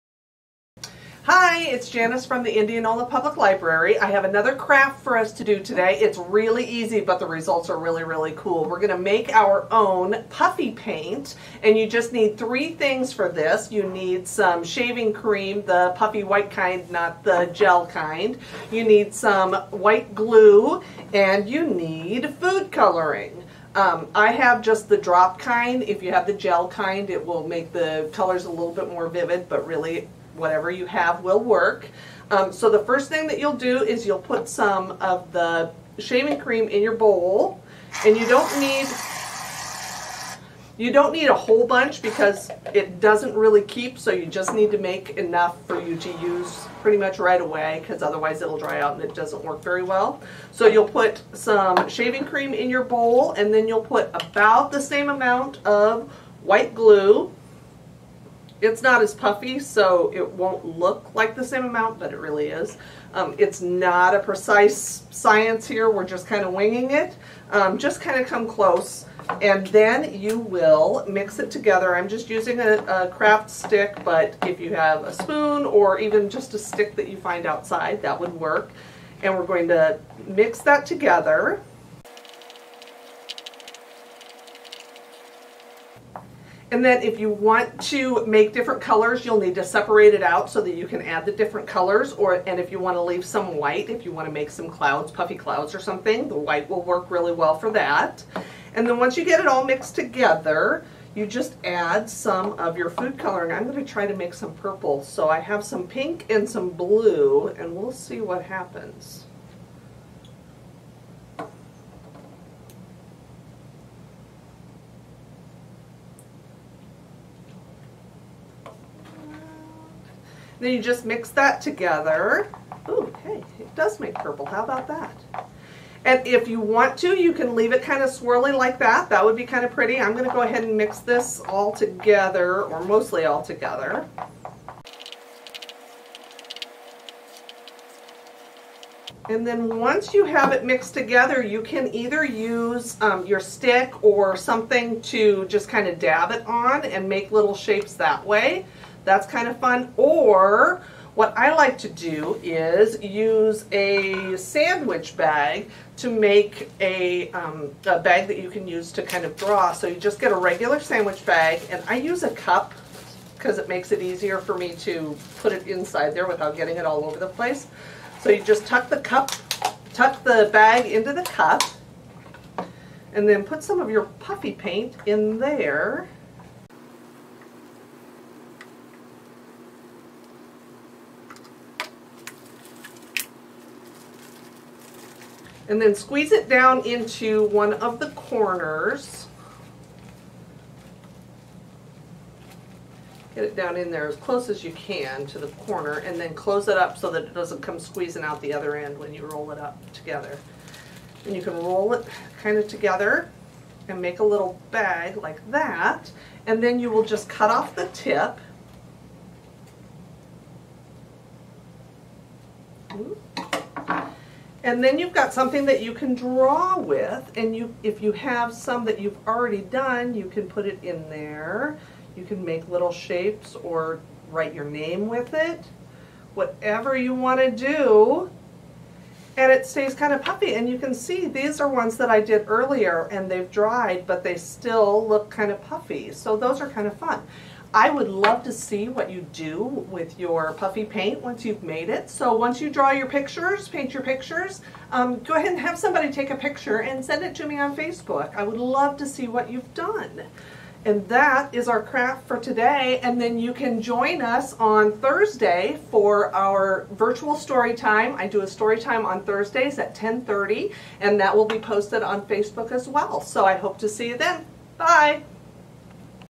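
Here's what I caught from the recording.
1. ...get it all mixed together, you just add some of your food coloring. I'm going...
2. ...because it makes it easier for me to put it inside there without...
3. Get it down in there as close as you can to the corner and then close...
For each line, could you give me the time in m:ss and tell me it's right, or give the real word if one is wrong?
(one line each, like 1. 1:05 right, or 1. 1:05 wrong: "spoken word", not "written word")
1. 1:39 right
2. 2:43 right
3. 3:13 right.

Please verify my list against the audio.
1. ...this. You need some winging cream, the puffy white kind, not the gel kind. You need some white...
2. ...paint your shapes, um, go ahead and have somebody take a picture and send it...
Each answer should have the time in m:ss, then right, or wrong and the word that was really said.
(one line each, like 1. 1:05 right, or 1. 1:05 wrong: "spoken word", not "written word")
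1. 0:13 wrong: "shaving", not "winging"
2. 4:03 wrong: "pictures", not "shapes".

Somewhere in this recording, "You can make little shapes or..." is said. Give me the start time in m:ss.
3:42.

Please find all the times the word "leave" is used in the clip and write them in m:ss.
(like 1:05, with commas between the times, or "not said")
1:33, 2:07.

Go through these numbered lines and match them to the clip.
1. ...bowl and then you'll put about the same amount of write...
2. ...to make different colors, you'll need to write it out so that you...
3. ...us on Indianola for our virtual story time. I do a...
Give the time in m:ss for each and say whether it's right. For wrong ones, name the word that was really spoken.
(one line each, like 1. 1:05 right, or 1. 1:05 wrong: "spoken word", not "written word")
1. 0:52 wrong: "white", not "write"
2. 1:27 wrong: "separate", not "write"
3. 4:14 wrong: "Thursday", not "Indianola".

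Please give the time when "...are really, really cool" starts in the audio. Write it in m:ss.
0:07.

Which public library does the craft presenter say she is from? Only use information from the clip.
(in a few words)
Indianola Public Library.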